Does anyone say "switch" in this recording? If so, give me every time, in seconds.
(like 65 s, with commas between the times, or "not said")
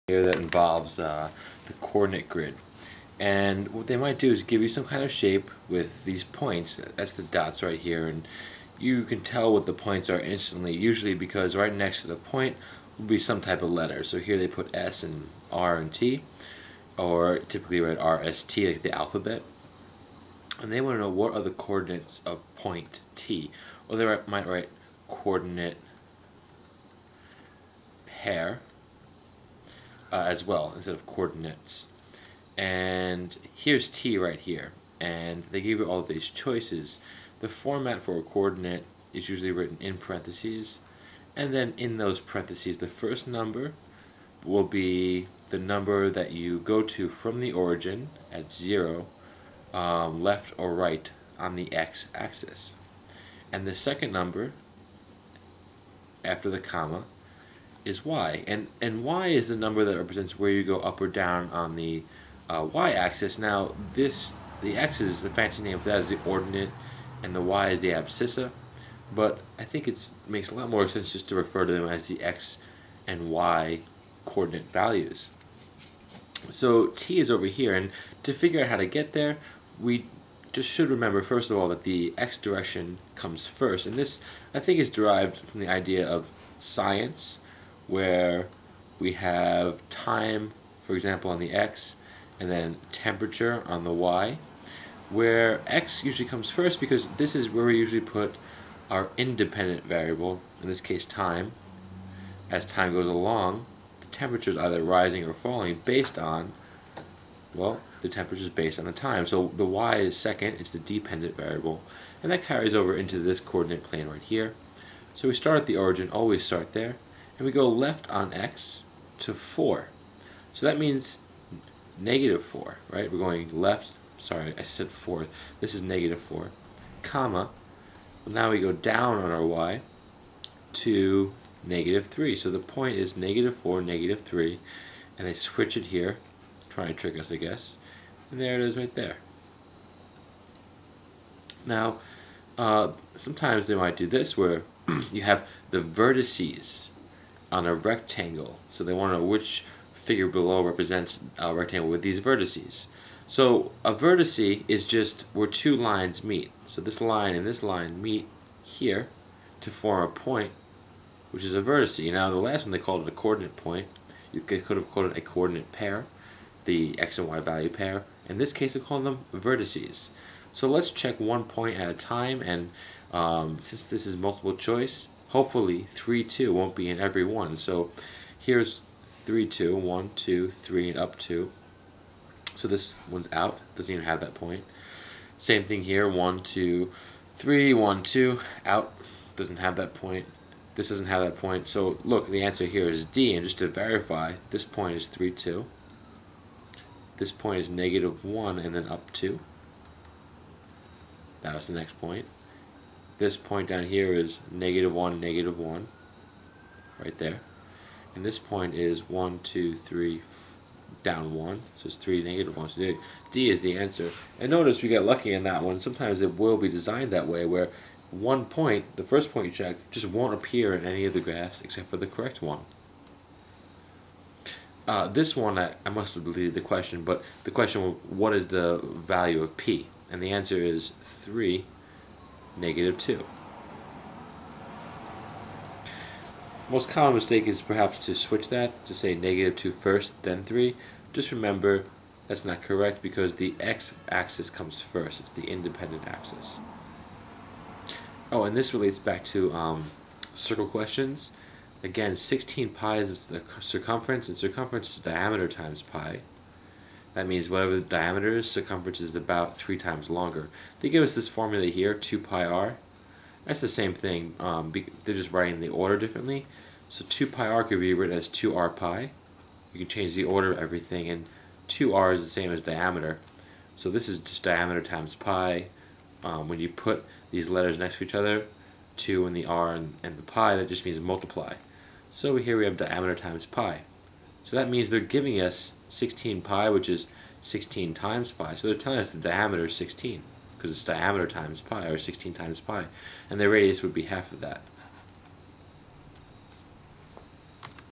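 135 s, 238 s.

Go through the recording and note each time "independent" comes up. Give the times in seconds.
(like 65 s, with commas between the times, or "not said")
99 s, 245 s.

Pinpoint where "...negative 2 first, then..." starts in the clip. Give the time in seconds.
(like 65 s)
239 s.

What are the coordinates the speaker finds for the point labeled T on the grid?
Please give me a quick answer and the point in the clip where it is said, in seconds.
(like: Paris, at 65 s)
-4, -3, at 133 s.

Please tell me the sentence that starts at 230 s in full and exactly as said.
And the answer is 3 negative 2.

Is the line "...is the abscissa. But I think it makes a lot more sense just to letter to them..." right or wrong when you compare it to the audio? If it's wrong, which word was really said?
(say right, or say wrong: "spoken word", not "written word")
wrong: "refer", not "letter".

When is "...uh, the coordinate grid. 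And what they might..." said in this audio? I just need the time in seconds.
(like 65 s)
0 s.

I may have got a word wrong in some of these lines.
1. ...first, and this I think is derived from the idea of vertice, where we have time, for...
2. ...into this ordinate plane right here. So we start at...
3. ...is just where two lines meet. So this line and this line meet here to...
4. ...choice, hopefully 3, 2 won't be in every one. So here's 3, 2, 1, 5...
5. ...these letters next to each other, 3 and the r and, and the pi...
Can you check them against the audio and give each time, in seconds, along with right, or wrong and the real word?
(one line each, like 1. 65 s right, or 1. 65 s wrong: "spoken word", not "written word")
1. 83 s wrong: "science", not "vertice"
2. 112 s wrong: "coordinate", not "ordinate"
3. 154 s right
4. 174 s wrong: "2", not "5"
5. 277 s wrong: "2", not "3".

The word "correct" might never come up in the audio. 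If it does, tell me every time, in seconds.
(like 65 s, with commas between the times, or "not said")
222 s, 242 s.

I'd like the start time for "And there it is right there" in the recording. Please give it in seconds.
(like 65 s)
138 s.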